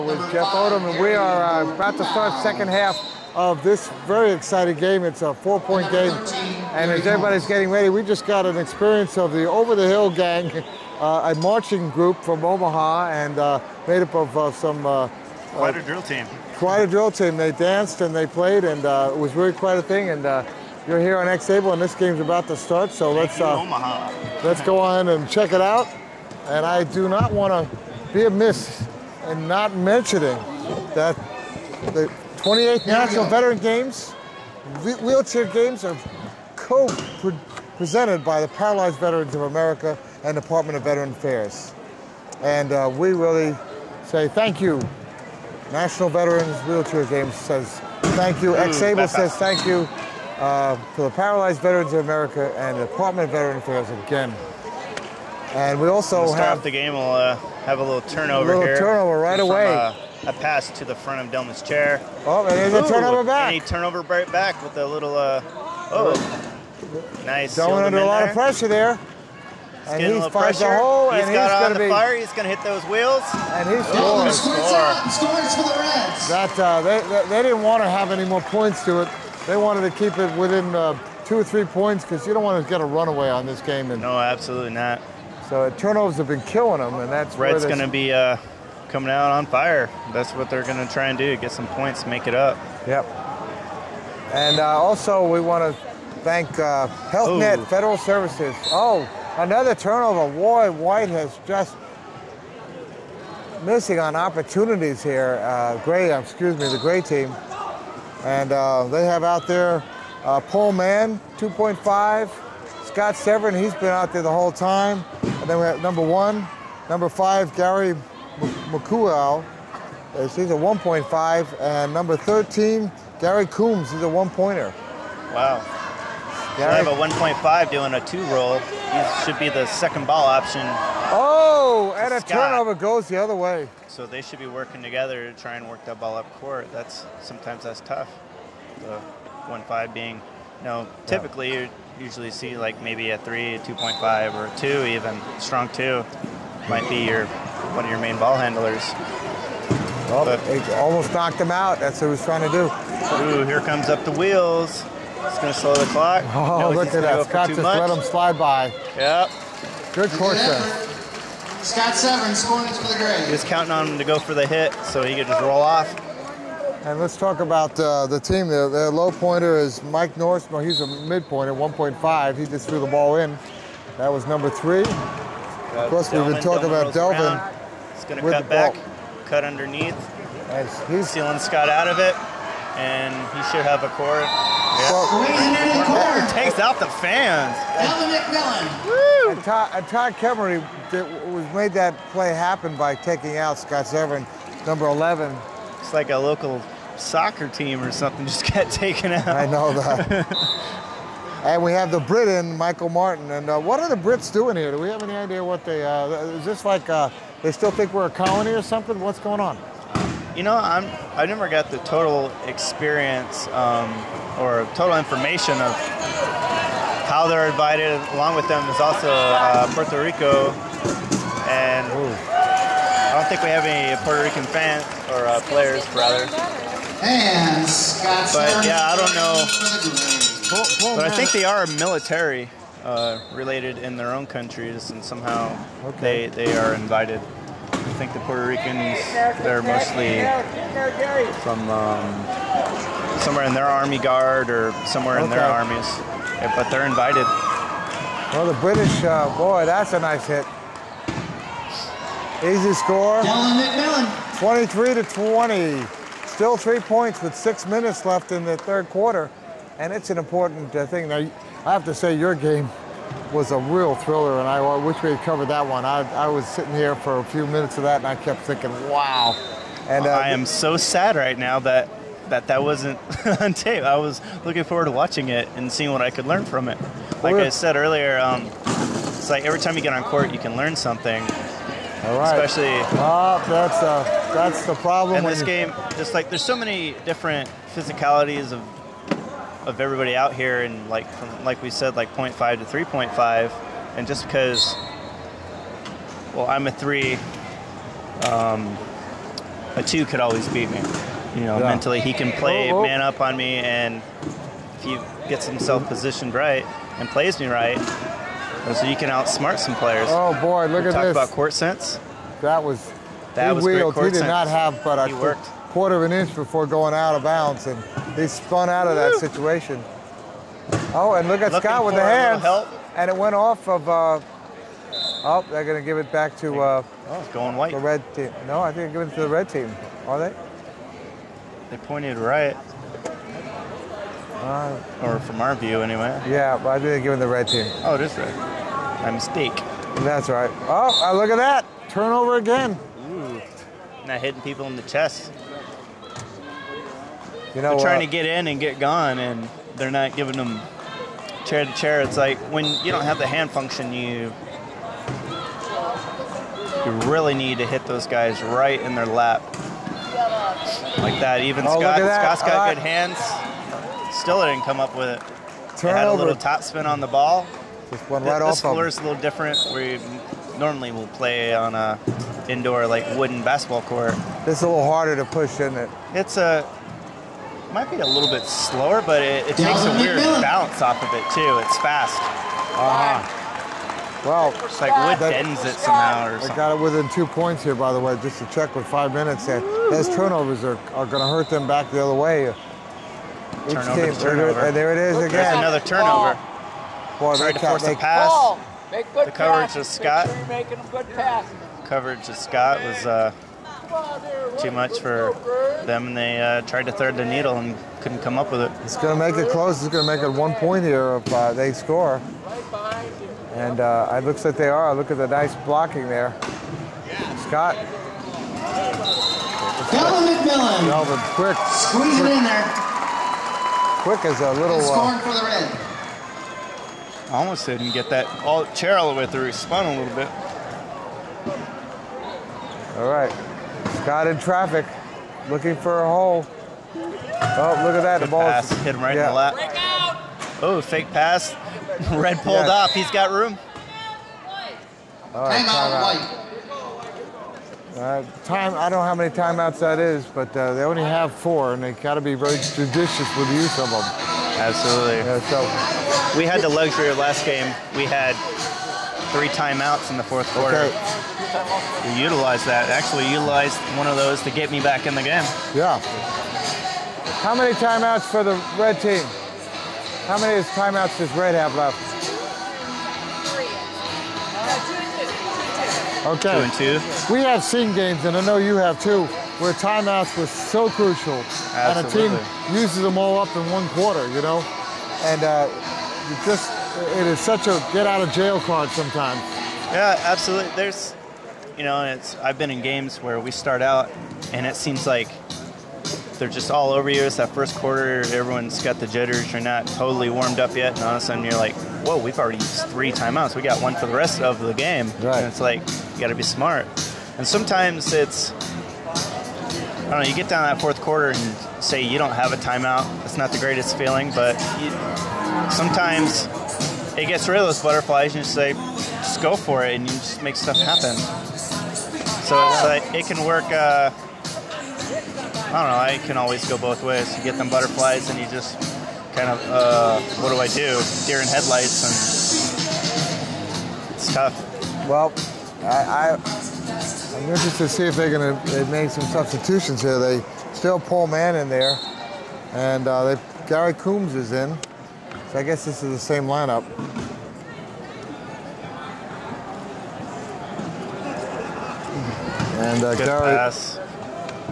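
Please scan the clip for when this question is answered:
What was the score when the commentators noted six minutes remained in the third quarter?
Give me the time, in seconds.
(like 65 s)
254 s.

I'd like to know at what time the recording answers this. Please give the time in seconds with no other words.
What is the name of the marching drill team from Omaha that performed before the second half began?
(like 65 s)
9 s.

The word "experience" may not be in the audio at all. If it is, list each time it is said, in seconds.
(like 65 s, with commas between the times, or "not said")
8 s, 212 s.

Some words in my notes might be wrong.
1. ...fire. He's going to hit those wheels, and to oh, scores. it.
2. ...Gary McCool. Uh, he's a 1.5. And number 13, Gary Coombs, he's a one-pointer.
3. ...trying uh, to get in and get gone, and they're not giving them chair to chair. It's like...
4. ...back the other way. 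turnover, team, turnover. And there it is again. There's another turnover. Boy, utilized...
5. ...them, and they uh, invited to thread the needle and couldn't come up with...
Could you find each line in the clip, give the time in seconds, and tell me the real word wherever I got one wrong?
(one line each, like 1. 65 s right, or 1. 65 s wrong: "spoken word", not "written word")
1. 71 s right
2. 117 s right
3. 347 s right
4. 391 s wrong: "tried", not "utilized"
5. 405 s wrong: "tried", not "invited".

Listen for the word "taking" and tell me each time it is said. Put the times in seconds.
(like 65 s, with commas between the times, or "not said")
192 s.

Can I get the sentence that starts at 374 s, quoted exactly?
This is a little harder to push, isn't it?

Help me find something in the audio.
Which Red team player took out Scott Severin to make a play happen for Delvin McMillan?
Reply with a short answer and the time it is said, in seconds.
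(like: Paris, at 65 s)
Todd Kemery, at 189 s.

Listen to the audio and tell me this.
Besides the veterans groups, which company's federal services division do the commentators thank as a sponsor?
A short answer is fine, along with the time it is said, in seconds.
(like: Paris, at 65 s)
HealthNet, at 97 s.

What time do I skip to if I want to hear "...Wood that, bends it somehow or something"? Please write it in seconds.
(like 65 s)
384 s.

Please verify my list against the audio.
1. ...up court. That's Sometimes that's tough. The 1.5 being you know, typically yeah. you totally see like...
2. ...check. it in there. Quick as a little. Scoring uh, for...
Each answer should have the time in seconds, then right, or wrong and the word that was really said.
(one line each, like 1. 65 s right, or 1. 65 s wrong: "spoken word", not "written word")
1. 136 s wrong: "usually", not "totally"
2. 422 s wrong: "quick", not "check".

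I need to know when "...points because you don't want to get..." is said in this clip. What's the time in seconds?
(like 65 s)
81 s.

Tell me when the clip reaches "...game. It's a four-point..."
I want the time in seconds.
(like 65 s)
4 s.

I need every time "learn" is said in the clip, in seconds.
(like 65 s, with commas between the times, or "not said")
276 s, 280 s.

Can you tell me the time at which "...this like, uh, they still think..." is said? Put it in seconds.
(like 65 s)
206 s.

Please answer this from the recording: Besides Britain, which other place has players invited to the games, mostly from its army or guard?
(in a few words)
Puerto Rico.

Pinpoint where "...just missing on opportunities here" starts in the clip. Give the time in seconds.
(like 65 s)
101 s.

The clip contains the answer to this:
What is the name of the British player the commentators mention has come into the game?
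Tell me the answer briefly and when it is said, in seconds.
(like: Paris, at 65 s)
Michael Martin, at 202 s.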